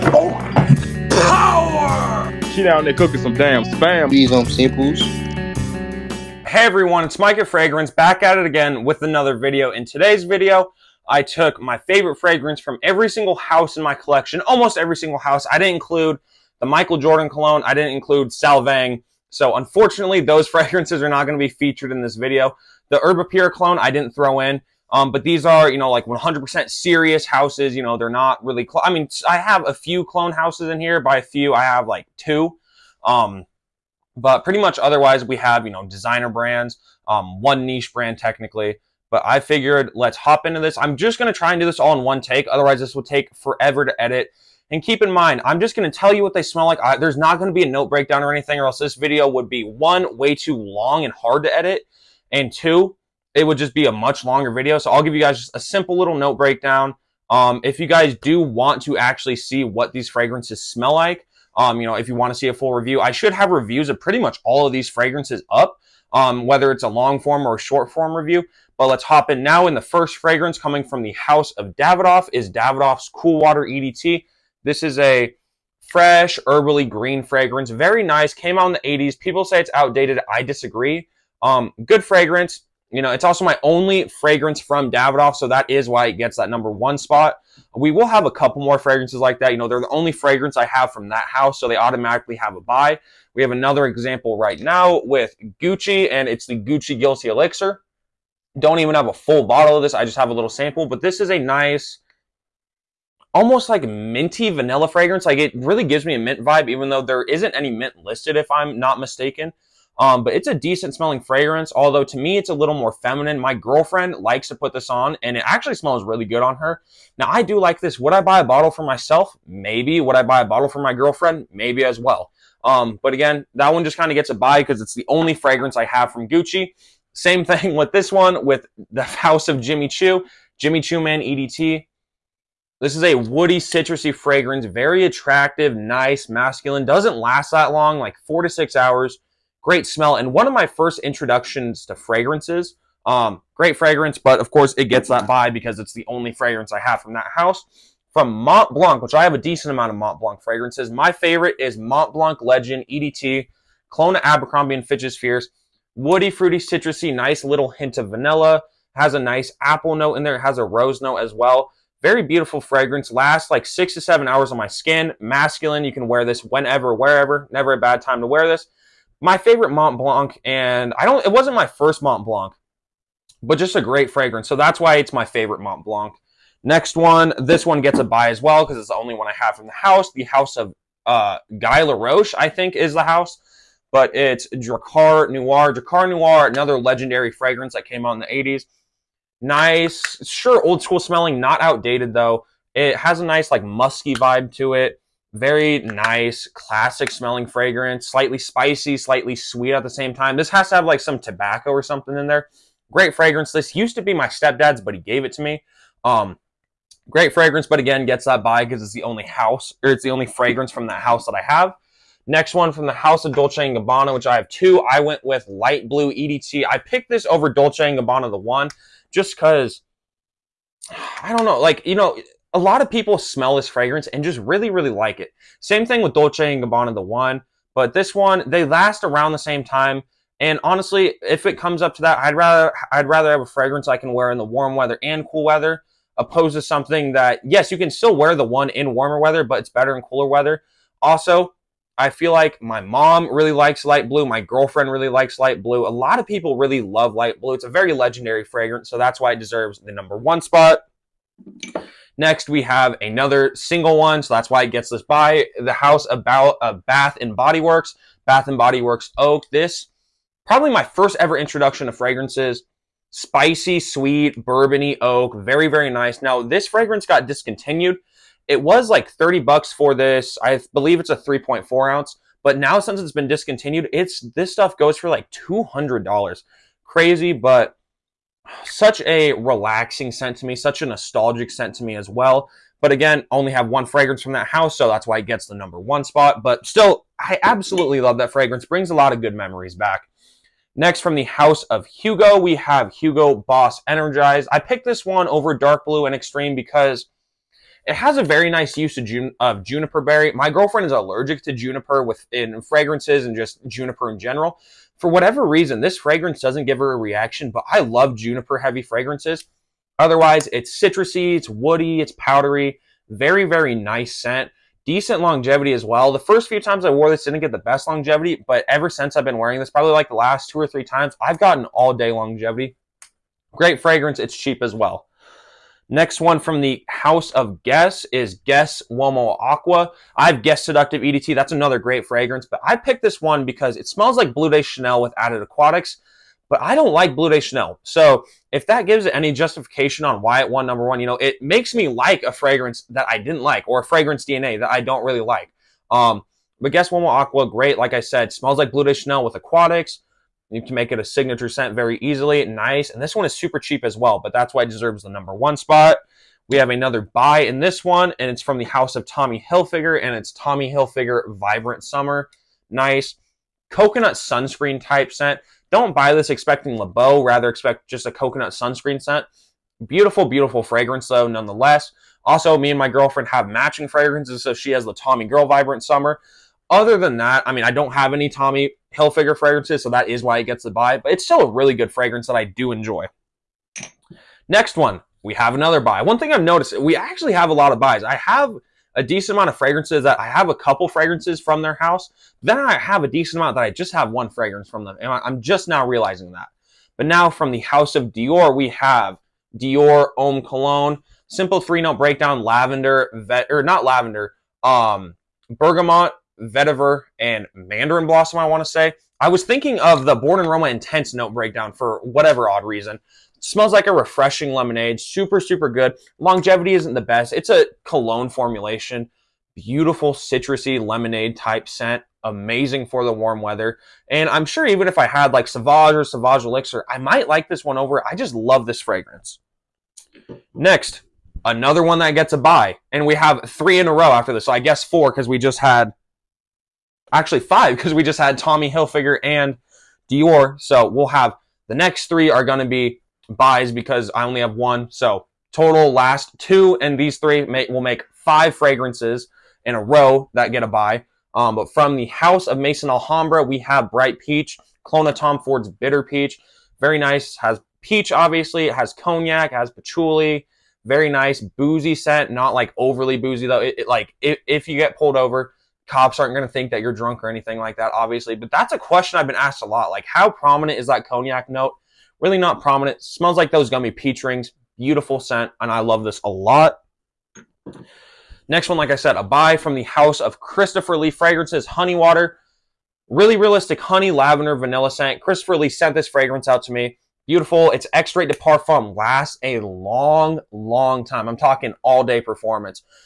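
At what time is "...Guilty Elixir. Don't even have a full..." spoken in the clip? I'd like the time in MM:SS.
01:36.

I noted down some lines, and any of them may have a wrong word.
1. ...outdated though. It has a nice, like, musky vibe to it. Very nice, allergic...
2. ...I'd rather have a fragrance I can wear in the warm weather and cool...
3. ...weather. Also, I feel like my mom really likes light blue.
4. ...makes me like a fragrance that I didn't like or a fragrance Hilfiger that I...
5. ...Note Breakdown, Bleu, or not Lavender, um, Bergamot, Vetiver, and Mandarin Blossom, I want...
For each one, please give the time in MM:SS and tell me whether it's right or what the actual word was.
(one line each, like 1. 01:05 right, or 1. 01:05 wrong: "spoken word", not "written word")
1. 03:11 wrong: "classic", not "allergic"
2. 03:52 right
3. 04:00 right
4. 05:41 wrong: "DNA", not "Hilfiger"
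5. 06:41 wrong: "Lavender", not "Bleu".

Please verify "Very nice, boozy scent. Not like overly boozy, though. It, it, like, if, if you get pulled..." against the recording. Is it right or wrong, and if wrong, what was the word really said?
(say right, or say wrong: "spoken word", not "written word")
right.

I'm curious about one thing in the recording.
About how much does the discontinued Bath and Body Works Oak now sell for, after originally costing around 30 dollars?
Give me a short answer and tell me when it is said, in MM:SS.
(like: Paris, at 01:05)
$200, at 04:35.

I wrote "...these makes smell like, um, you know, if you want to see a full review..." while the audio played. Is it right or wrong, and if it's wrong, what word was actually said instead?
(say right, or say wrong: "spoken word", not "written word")
wrong: "fragrances", not "makes".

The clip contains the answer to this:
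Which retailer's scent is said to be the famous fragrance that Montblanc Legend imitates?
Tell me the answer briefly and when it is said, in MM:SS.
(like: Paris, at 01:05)
Abercrombie and Fitch, at 02:34.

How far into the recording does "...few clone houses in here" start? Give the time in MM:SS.
00:29.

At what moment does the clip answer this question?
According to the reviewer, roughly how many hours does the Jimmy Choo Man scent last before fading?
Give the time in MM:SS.
02:18.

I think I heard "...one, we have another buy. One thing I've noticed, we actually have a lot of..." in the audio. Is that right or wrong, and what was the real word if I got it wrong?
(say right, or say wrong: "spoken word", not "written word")
right.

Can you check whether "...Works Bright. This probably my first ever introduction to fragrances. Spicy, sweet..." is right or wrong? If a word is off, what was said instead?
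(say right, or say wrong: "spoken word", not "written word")
wrong: "Oak", not "Bright".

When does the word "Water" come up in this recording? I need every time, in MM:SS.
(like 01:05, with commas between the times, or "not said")
01:13, 08:01.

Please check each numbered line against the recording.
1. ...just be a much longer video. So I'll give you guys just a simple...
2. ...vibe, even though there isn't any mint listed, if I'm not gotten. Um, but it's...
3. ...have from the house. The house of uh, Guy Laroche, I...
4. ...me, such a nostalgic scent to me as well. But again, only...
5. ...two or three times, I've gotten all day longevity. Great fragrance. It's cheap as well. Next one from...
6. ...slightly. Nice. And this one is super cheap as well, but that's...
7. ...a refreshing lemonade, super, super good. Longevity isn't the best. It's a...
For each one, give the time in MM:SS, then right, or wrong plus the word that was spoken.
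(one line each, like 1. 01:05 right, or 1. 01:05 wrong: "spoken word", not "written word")
1. 00:53 right
2. 01:46 wrong: "mistaken", not "gotten"
3. 02:59 right
4. 04:40 right
5. 05:20 right
6. 05:51 wrong: "easily", not "slightly"
7. 06:53 right.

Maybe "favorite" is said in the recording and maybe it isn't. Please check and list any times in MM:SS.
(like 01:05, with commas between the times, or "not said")
00:11, 02:31, 02:49, 02:55.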